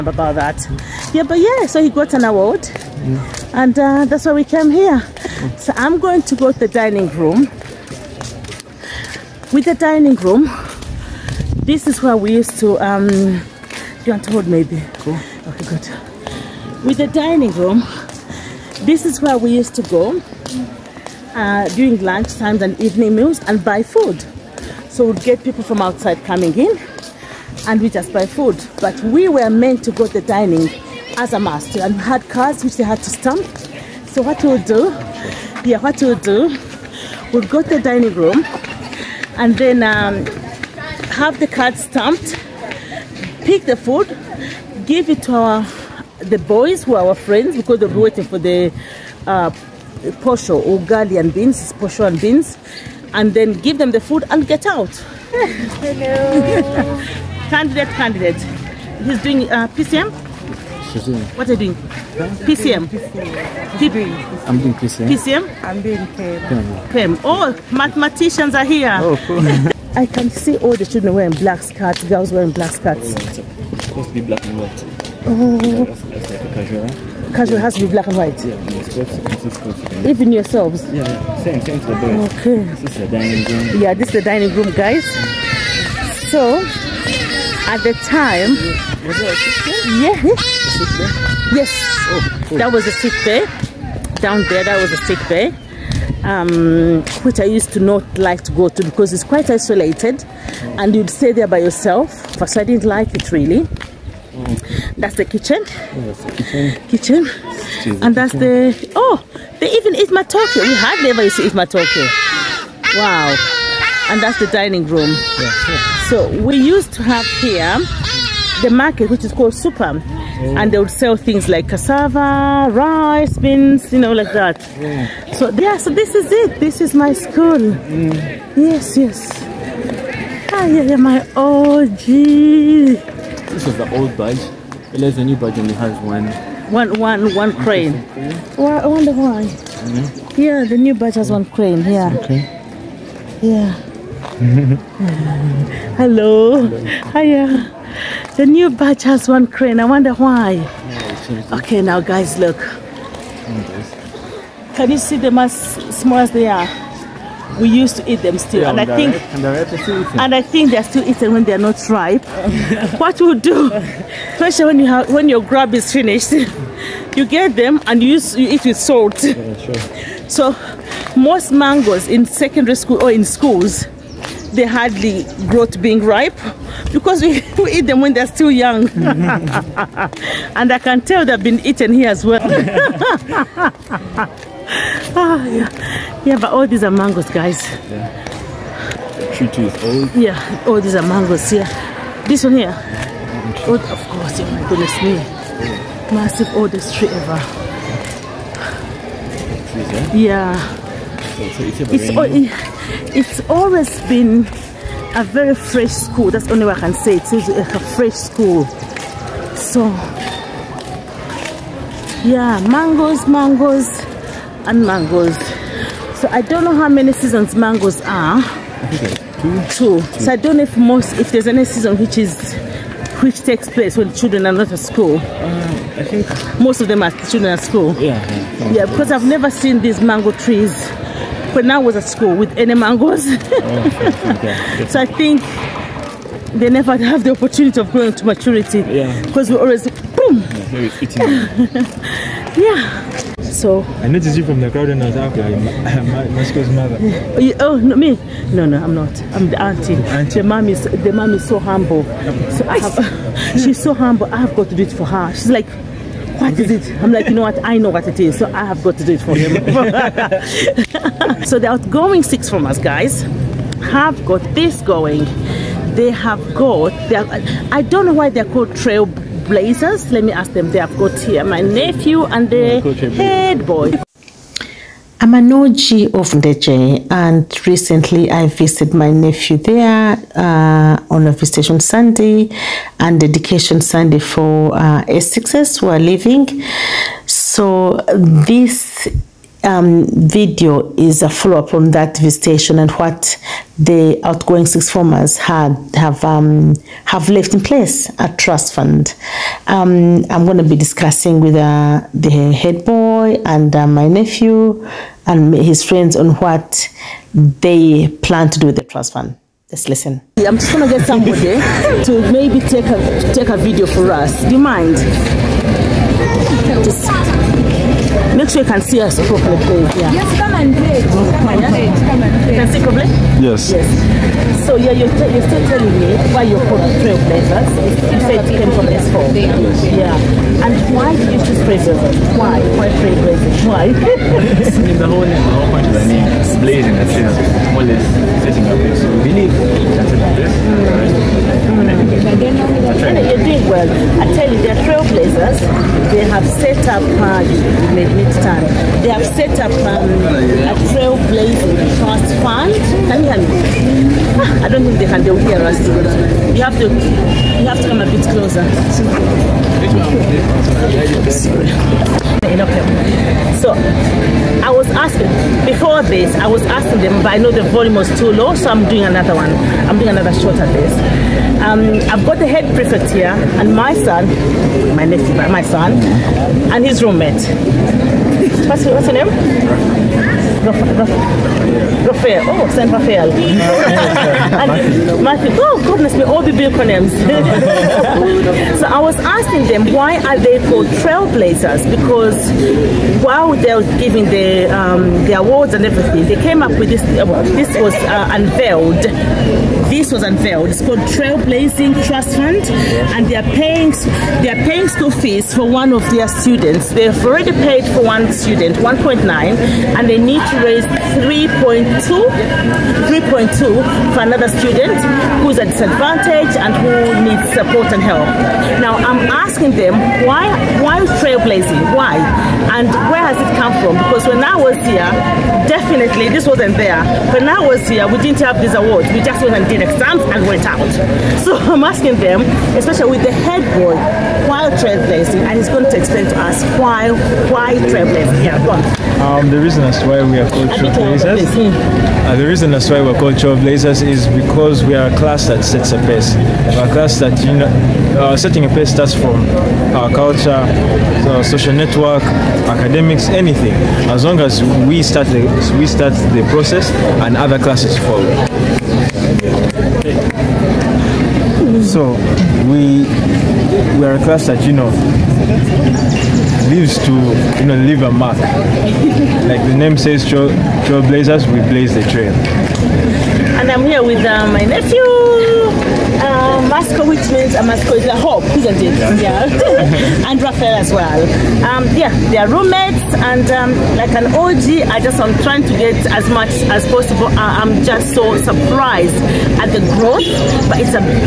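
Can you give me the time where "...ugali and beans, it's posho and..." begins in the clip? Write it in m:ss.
0:50.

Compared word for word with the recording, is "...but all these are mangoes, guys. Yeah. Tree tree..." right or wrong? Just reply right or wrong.
right.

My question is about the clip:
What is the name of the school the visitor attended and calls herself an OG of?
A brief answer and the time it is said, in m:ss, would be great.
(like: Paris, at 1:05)
Ndejje, at 4:35.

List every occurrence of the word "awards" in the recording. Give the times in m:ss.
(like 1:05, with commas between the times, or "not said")
0:02, 6:35, 7:08.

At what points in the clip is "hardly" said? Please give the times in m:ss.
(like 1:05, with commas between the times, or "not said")
1:50, 2:54.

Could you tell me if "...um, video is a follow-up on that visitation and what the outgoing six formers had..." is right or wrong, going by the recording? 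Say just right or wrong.
right.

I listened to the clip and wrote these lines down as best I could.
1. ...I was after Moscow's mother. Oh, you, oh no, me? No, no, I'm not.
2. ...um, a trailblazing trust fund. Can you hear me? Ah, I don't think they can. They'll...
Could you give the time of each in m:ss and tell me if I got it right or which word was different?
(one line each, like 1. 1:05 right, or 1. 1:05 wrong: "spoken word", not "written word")
1. 4:05 right
2. 5:49 right.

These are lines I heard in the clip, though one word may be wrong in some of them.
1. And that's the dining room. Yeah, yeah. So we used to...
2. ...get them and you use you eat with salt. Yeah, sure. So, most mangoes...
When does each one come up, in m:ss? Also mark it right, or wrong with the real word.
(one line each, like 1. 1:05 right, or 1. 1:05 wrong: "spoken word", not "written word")
1. 1:54 right
2. 2:47 right.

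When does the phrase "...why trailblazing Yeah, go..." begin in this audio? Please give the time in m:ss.
7:17.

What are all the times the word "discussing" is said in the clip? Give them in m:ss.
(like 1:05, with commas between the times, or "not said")
5:00.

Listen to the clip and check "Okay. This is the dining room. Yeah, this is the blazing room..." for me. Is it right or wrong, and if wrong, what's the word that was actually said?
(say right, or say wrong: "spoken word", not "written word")
wrong: "dining", not "blazing".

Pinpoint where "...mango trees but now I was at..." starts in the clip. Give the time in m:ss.
3:50.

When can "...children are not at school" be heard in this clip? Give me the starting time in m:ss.
3:44.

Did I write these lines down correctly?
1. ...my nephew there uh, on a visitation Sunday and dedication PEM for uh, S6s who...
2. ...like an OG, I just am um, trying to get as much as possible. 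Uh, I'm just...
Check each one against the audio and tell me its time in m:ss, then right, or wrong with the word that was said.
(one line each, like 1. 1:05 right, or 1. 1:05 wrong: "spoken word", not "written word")
1. 4:38 wrong: "Sunday", not "PEM"
2. 8:03 right.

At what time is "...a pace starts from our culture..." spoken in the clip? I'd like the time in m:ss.
7:28.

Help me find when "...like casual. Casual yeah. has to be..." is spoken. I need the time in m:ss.
1:16.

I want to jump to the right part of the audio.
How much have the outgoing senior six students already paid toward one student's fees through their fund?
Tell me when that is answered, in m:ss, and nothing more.
6:48.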